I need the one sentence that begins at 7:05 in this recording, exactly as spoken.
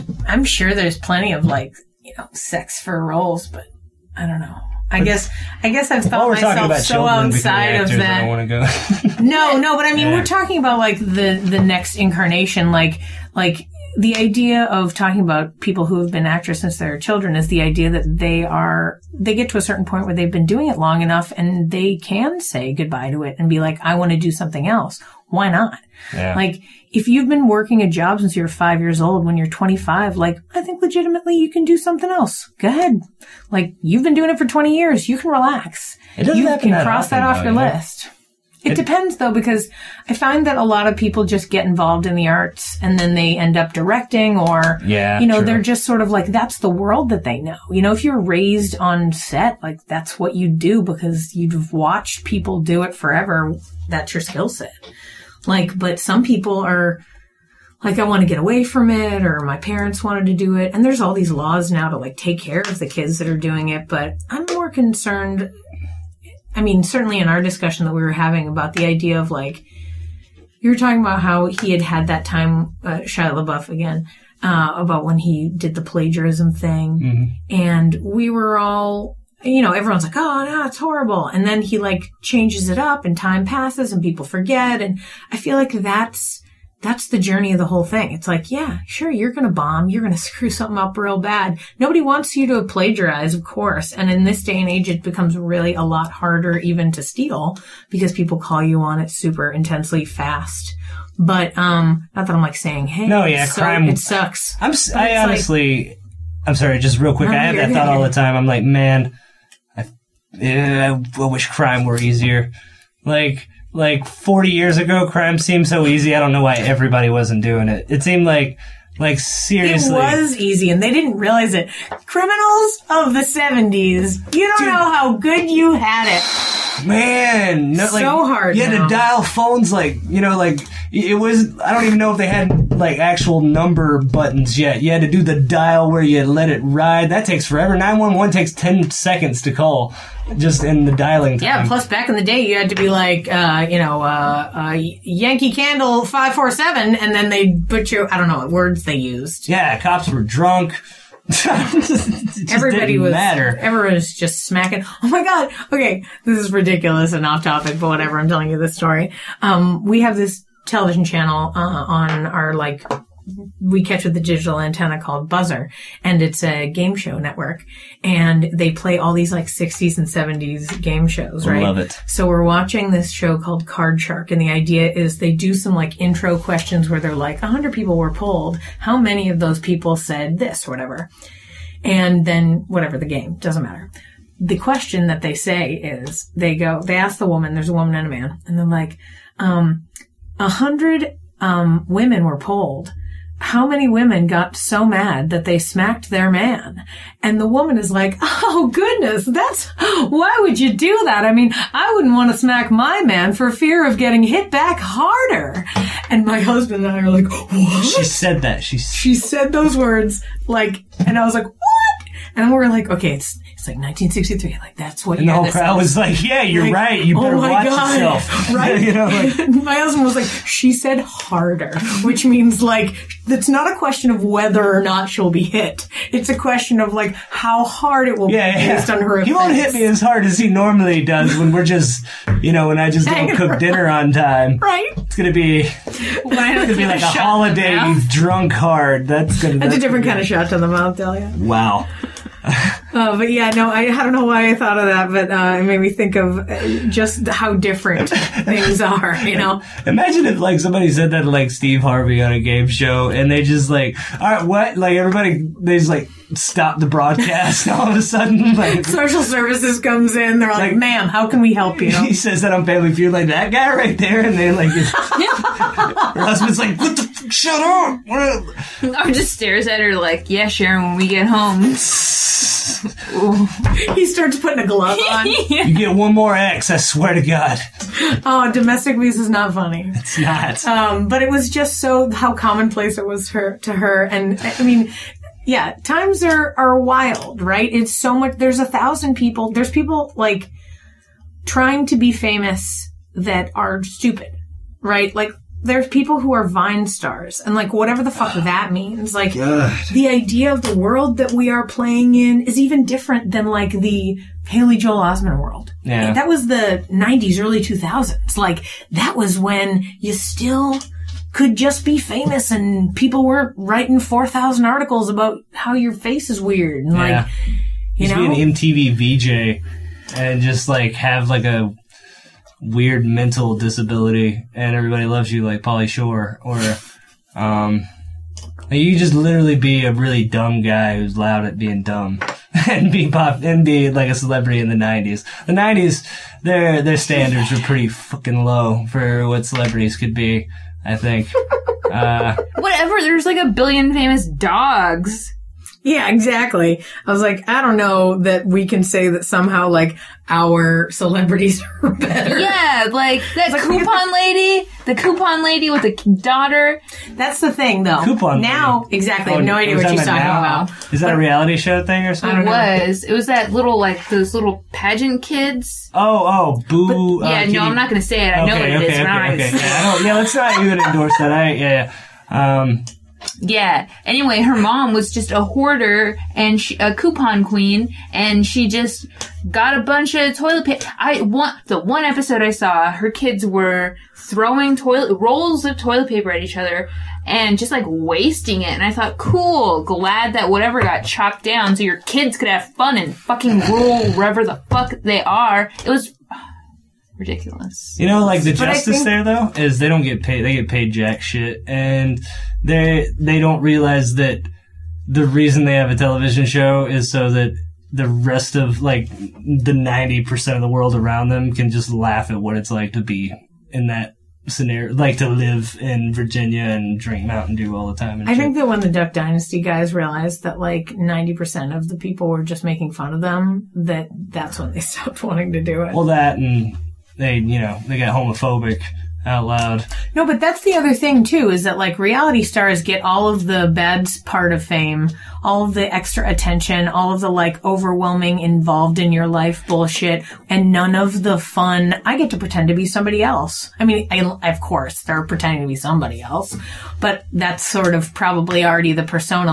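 Well, that and they you know they get homophobic out loud.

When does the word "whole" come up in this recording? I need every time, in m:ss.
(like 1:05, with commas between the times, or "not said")
1:27, 3:35.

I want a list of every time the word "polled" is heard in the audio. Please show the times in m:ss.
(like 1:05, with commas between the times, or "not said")
2:58, 3:12.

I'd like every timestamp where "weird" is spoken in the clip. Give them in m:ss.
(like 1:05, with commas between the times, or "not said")
5:16, 5:22.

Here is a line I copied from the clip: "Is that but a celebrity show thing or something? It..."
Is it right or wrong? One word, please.
wrong.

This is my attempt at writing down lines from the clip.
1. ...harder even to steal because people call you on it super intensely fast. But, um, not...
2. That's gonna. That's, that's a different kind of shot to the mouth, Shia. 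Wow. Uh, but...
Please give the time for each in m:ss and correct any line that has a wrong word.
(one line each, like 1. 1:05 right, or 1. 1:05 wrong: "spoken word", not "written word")
1. 1:36 right
2. 3:59 wrong: "Delia", not "Shia".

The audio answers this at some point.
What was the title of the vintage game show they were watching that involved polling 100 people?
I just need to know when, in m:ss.
2:53.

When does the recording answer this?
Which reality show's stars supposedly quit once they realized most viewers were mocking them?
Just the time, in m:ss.
6:58.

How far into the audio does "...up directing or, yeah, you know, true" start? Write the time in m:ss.
0:43.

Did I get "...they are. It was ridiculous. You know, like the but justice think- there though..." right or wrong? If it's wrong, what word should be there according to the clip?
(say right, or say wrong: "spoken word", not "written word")
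right.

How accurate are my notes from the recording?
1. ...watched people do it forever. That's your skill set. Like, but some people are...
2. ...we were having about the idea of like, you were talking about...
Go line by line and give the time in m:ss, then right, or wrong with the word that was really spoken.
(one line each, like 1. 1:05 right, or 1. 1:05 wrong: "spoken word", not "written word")
1. 0:51 right
2. 1:07 right.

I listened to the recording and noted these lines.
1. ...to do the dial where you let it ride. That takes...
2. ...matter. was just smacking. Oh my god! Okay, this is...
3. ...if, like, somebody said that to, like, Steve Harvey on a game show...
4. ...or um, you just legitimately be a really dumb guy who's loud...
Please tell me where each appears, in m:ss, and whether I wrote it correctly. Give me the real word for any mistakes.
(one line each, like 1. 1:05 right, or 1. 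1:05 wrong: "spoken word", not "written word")
1. 2:15 right
2. 2:33 right
3. 4:10 right
4. 5:26 wrong: "literally", not "legitimately".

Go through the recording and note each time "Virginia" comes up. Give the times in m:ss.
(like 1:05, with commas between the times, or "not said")
6:56.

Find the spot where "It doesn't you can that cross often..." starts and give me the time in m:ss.
0:36.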